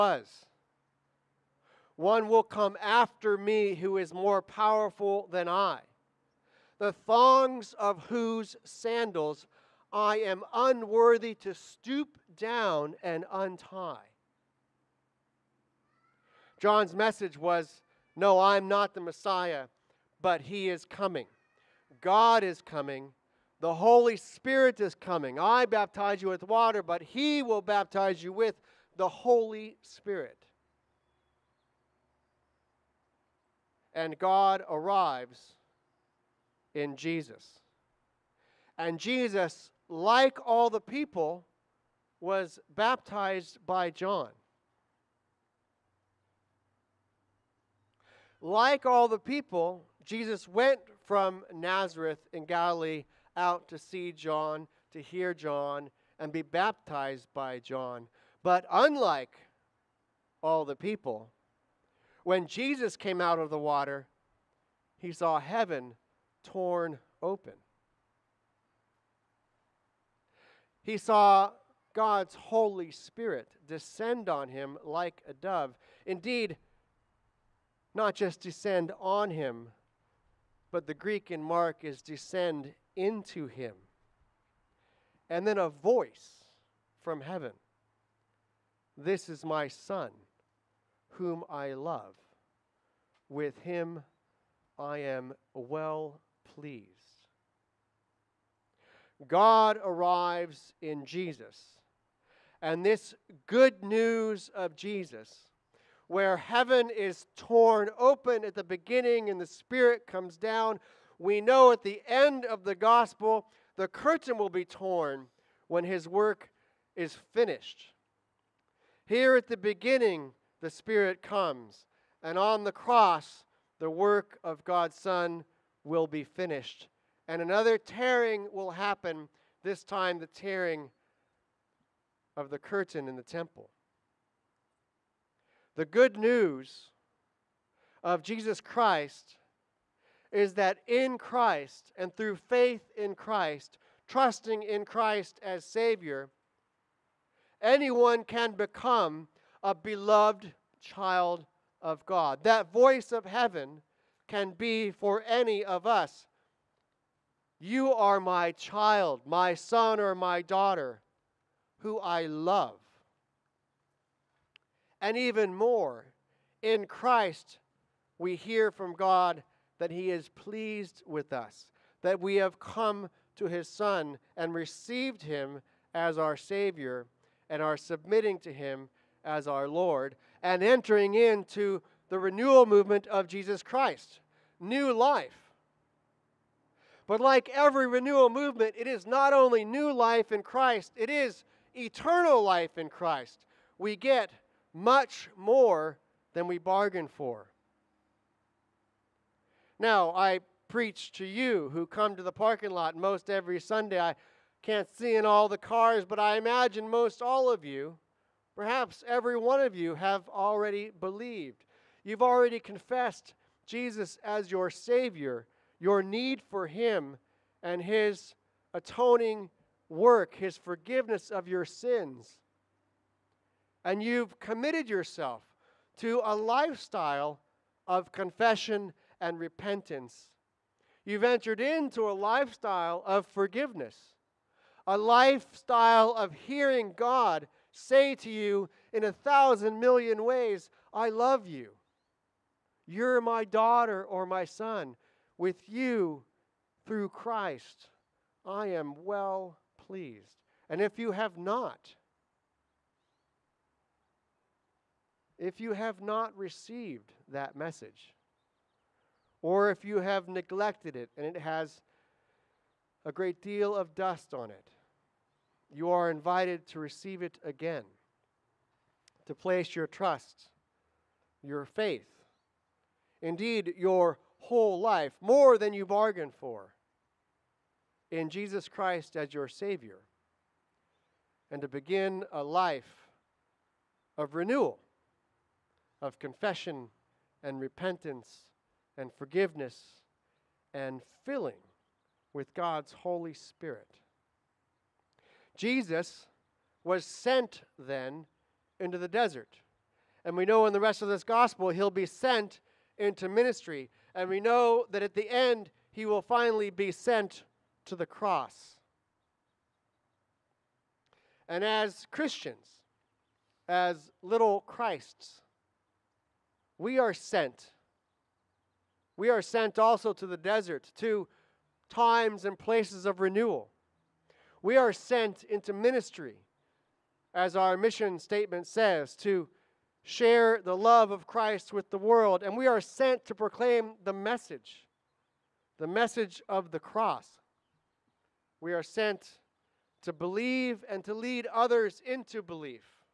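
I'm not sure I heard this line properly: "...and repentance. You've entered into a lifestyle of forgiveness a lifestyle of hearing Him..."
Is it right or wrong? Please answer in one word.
wrong.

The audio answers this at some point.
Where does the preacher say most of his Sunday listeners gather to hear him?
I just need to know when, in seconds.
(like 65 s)
202 s.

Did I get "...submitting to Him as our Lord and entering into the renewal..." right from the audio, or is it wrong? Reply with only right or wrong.
right.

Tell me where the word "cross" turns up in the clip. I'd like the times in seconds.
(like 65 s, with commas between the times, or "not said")
122 s, 308 s, 336 s.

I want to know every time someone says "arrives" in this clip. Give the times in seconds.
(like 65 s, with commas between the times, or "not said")
34 s, 99 s.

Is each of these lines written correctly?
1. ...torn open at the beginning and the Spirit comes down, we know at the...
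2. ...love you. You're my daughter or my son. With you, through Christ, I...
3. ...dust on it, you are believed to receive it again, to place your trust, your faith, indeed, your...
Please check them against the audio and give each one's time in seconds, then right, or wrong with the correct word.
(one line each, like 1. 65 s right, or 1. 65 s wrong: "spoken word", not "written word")
1. 107 s right
2. 241 s right
3. 263 s wrong: "invited", not "believed".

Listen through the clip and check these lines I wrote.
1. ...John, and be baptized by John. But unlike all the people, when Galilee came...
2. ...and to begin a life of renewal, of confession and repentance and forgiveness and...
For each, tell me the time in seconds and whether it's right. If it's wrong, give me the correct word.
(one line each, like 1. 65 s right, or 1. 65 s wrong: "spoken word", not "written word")
1. 55 s wrong: "Jesus", not "Galilee"
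2. 281 s right.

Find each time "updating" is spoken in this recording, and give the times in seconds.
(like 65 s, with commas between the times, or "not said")
not said.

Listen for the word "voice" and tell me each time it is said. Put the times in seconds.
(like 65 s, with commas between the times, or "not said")
85 s, 152 s.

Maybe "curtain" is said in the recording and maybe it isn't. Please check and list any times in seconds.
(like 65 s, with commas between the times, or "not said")
113 s, 132 s.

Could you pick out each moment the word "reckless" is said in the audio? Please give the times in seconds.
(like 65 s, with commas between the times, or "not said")
not said.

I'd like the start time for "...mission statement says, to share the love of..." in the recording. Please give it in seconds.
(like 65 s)
327 s.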